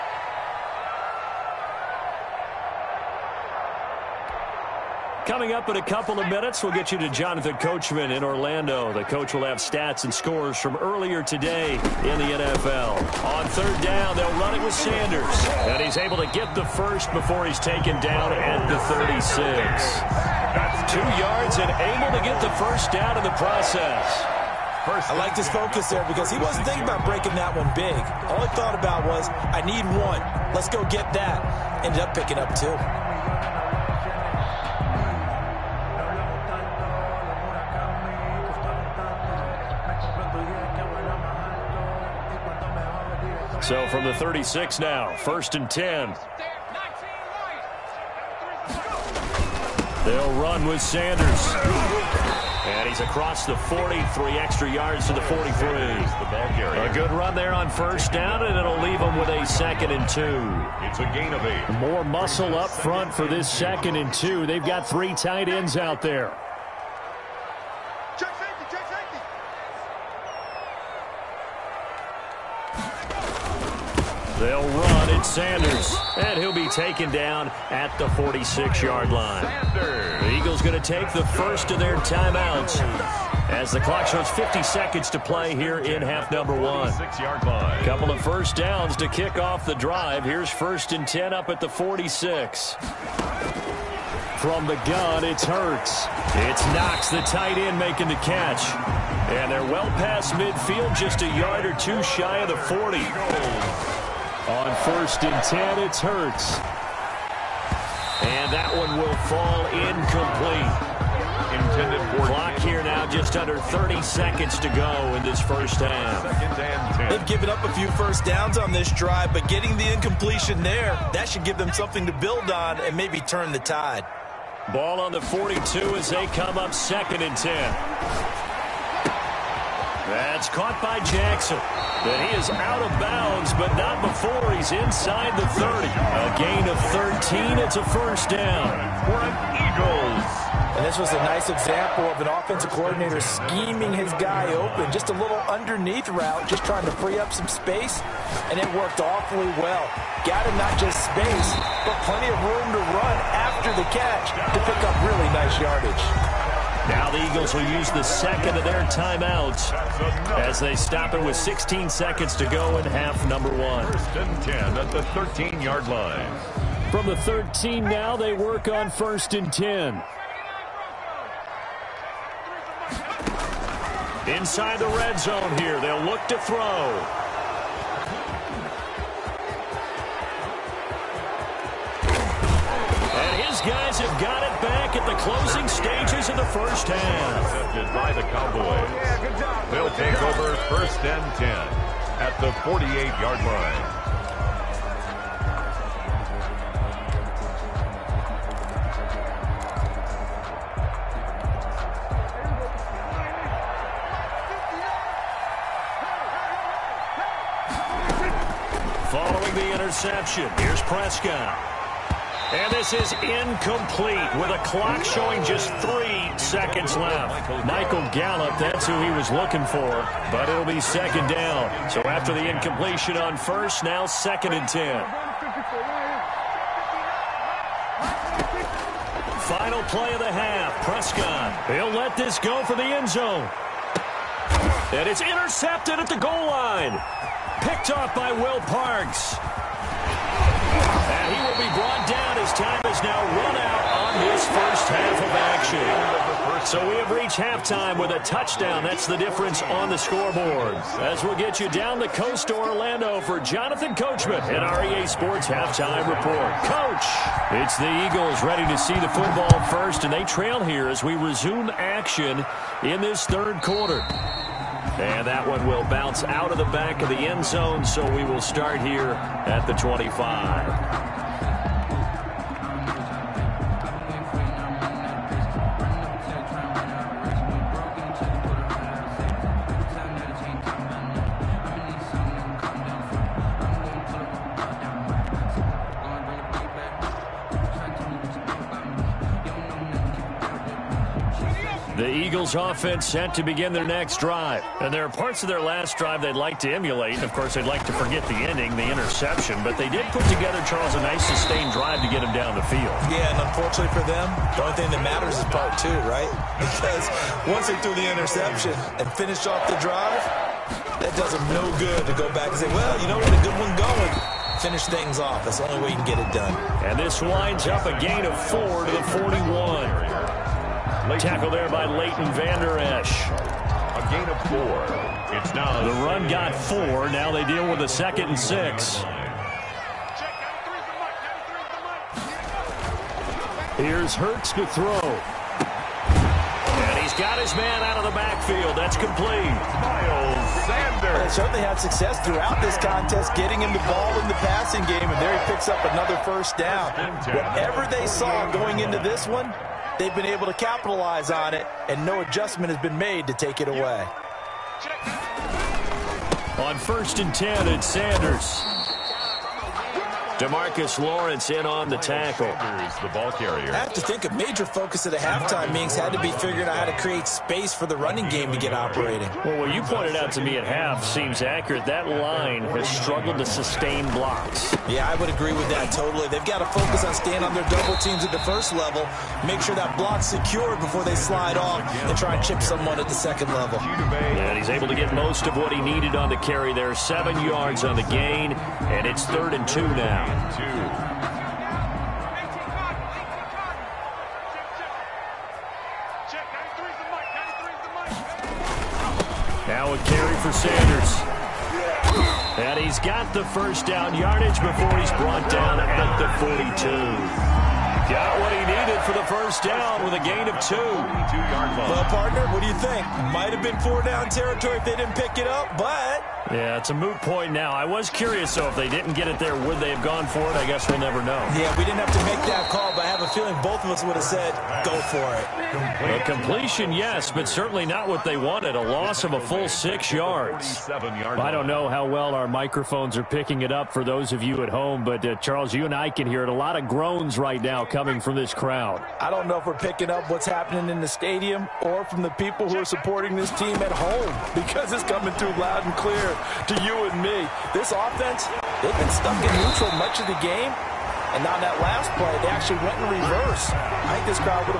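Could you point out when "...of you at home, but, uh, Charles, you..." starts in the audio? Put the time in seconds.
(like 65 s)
434 s.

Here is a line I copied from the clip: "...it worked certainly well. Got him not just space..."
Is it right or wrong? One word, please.
wrong.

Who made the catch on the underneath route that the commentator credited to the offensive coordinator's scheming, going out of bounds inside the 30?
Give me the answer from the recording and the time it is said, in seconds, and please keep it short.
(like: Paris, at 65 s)
Jackson, at 131 s.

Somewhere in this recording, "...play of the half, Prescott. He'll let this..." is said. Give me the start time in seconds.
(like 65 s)
229 s.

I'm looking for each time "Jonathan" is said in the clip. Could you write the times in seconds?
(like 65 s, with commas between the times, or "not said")
7 s, 253 s.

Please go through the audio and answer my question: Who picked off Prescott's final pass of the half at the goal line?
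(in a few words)
Will Parks.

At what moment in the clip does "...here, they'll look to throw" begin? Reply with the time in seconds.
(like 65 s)
175 s.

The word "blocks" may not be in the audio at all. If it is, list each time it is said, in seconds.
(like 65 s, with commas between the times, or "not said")
374 s, 379 s.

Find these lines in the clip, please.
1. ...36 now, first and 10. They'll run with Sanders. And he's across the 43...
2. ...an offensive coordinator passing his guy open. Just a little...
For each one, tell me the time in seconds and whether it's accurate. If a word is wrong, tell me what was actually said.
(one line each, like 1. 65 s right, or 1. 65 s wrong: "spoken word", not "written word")
1. 44 s right
2. 142 s wrong: "scheming", not "passing".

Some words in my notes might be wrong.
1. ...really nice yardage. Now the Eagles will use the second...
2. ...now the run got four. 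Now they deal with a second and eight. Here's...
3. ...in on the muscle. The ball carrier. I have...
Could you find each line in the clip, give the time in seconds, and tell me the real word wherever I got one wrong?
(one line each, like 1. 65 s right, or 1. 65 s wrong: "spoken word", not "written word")
1. 155 s right
2. 325 s wrong: "six", not "eight"
3. 361 s wrong: "tackle", not "muscle".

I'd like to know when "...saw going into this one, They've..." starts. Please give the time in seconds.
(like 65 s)
348 s.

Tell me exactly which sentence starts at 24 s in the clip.
I liked his focus there because he wasn't thinking about breaking that one big.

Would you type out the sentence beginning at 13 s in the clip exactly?
On third down, they'll run it with Sanders.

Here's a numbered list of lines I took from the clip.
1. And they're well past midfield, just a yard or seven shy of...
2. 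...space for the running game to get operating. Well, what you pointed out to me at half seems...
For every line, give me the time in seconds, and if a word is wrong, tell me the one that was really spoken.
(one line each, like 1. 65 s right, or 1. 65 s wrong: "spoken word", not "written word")
1. 99 s wrong: "two", not "seven"
2. 367 s right.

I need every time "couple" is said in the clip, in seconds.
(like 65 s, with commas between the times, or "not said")
5 s, 87 s.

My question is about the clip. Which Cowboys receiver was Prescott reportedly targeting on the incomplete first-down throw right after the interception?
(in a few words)
Michael Gallup.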